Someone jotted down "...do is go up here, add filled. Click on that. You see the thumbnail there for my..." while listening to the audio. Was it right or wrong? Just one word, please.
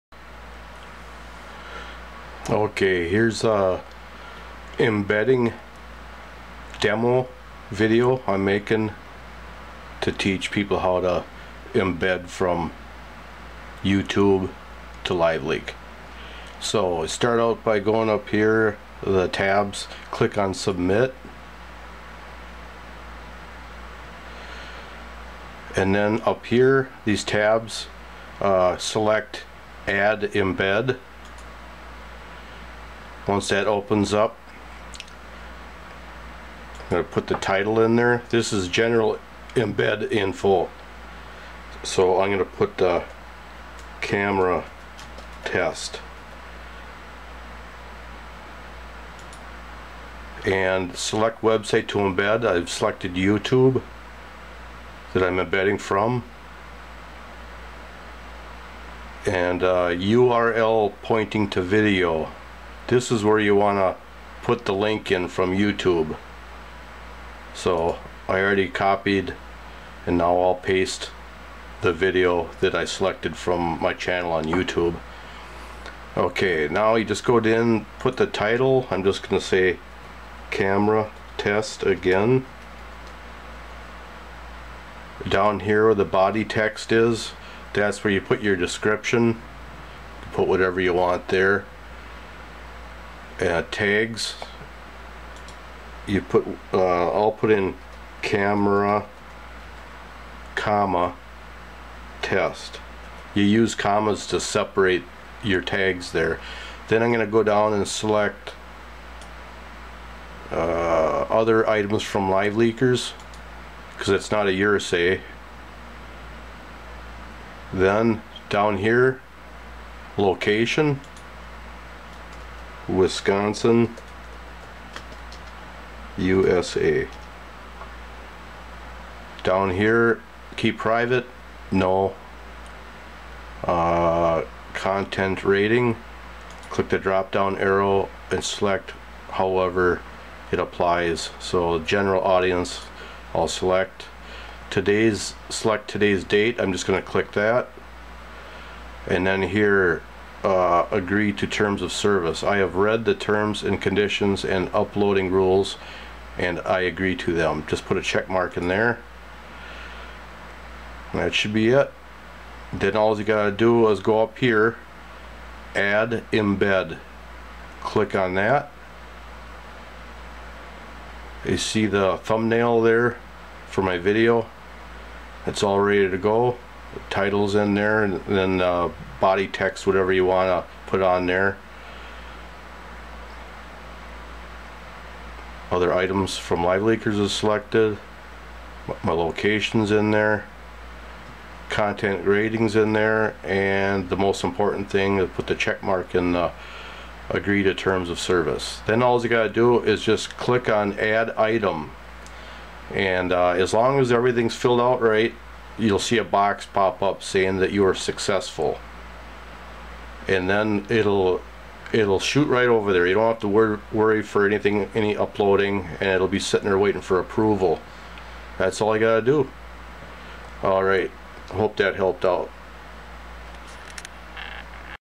wrong.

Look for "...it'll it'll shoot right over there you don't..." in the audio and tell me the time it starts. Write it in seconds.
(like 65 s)
210 s.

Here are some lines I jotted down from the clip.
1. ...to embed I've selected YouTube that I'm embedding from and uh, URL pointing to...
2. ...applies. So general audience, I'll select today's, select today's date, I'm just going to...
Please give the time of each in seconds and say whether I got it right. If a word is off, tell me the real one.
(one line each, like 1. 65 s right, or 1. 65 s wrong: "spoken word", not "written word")
1. 51 s right
2. 140 s right.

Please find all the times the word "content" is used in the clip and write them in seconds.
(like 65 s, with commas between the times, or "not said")
134 s, 191 s.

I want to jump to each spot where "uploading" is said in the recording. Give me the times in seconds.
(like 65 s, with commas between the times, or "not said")
154 s, 215 s.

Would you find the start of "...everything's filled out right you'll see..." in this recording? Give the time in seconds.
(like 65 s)
204 s.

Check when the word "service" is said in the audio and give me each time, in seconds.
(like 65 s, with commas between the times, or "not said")
151 s, 198 s.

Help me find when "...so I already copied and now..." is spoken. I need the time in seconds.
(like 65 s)
67 s.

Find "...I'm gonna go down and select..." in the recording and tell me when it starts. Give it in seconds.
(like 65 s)
107 s.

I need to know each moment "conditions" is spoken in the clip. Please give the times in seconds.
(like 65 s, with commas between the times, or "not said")
153 s.